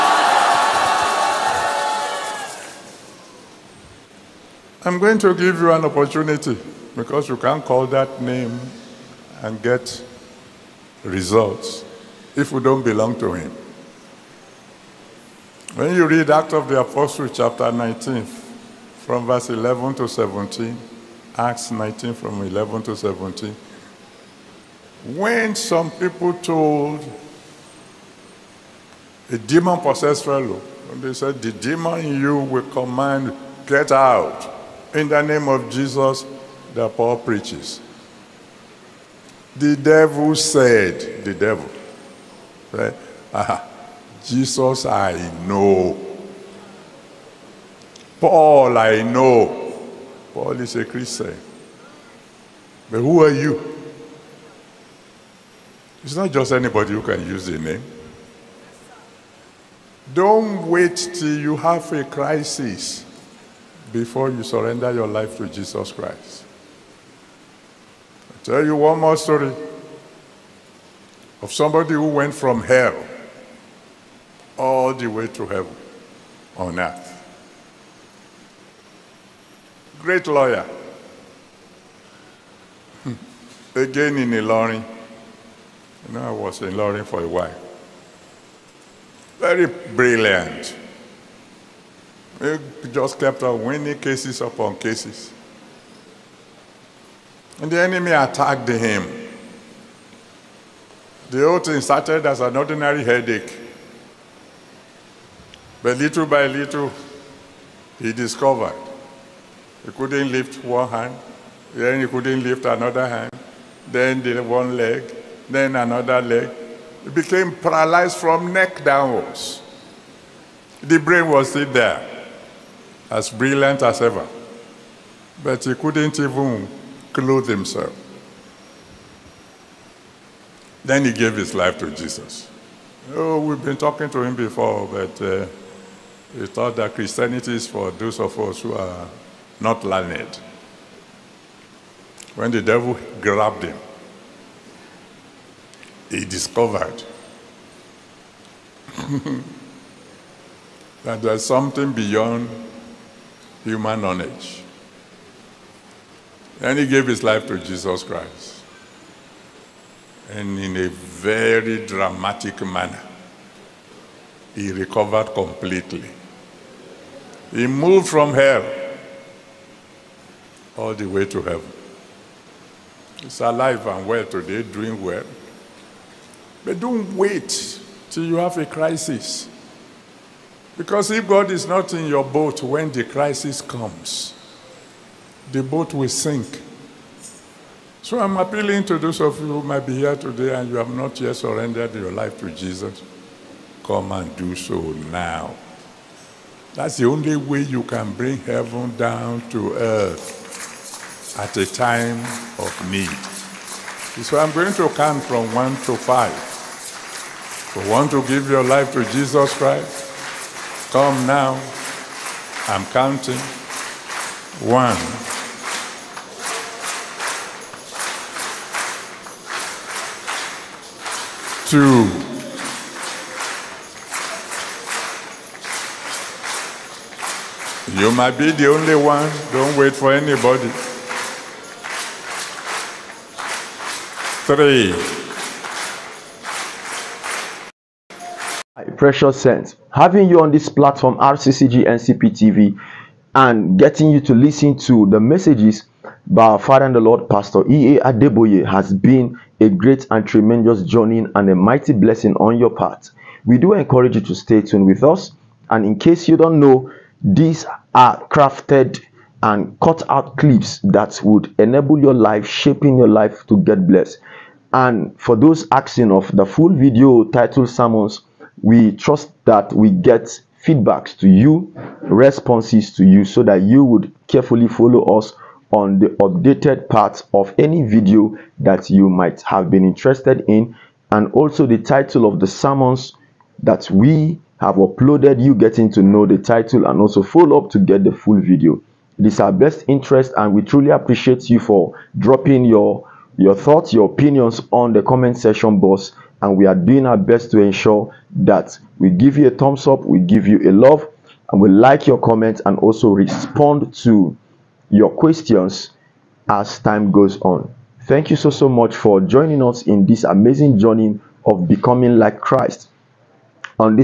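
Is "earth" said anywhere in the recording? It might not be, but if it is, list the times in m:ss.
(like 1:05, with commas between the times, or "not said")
1:16, 3:19.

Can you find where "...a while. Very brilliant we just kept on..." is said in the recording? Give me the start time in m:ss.
1:27.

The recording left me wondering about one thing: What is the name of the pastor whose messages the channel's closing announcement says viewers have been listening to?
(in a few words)
E.A. Adeboye.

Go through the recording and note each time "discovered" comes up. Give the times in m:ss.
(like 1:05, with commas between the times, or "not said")
1:48, 2:26.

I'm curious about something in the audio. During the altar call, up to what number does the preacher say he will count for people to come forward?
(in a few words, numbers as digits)
5.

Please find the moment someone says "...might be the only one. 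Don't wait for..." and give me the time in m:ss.
3:48.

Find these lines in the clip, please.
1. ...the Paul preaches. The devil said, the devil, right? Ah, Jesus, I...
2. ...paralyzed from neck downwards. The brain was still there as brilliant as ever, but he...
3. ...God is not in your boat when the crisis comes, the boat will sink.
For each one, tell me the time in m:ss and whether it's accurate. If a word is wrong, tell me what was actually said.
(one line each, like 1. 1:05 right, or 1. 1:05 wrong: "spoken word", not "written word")
1. 0:36 right
2. 1:57 right
3. 3:01 right.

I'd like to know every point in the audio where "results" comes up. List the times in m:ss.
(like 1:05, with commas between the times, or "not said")
0:11.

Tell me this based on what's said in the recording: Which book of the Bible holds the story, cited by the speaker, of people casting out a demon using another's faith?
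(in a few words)
Acts of the Apostles.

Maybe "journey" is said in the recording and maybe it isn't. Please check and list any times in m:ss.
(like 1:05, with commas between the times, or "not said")
4:10, 5:10.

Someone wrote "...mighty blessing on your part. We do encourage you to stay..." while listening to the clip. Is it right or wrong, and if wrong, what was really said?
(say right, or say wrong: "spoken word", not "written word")
right.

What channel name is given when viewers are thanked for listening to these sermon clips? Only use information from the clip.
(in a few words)
RCCG NCP TV.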